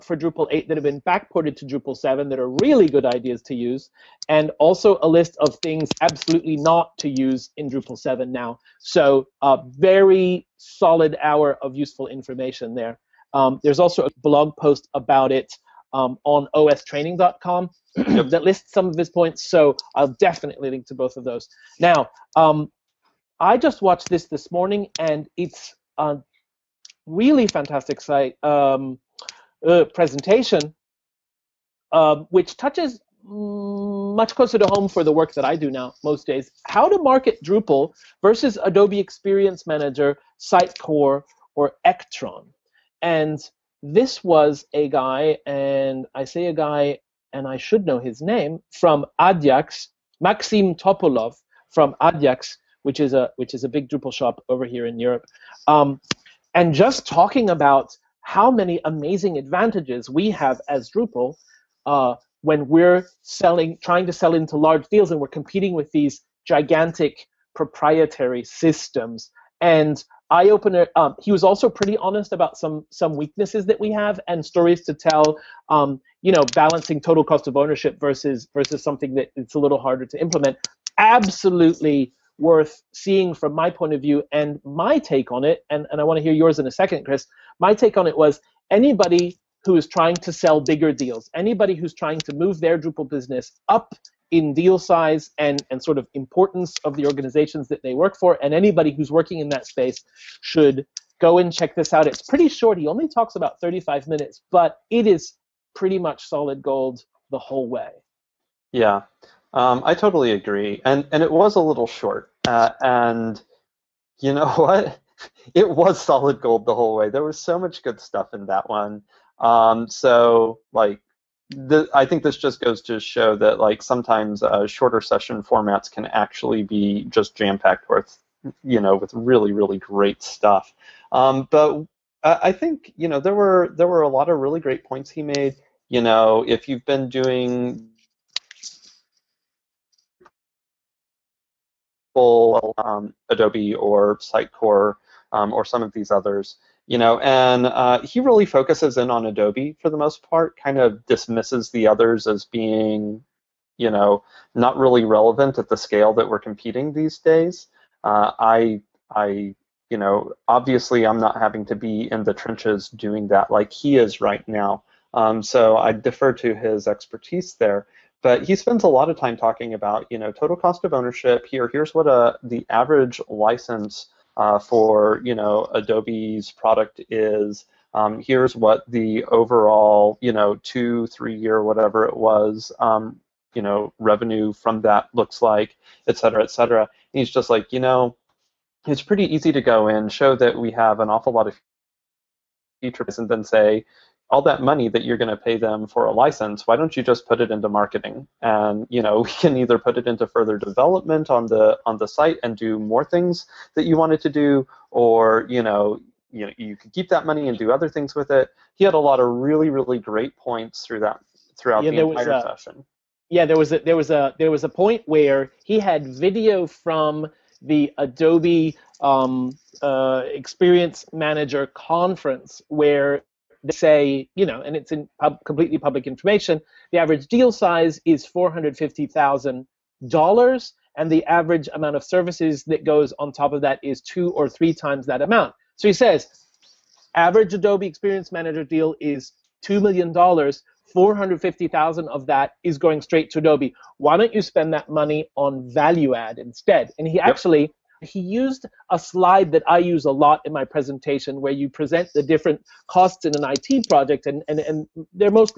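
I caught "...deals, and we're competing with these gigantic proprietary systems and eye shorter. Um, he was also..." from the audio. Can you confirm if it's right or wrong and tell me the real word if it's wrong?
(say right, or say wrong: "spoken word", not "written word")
wrong: "opener", not "shorter".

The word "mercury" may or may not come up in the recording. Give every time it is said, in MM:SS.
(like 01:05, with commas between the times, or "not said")
not said.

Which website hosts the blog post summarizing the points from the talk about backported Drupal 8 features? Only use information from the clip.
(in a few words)
ostraining.com.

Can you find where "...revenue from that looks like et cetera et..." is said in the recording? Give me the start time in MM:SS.
03:03.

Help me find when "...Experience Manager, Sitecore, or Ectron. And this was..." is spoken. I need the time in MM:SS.
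00:38.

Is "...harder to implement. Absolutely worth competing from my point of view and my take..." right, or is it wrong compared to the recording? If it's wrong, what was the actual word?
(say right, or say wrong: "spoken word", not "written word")
wrong: "seeing", not "competing".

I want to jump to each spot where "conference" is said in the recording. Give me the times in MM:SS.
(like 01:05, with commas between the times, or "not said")
03:41.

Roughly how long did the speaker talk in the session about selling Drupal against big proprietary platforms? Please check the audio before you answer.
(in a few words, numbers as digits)
35 minutes.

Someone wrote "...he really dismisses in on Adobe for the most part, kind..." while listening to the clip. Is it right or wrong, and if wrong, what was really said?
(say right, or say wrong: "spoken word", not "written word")
wrong: "focuses", not "dismisses".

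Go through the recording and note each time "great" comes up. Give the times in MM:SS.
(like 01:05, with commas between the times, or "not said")
02:09, 02:14, 03:29.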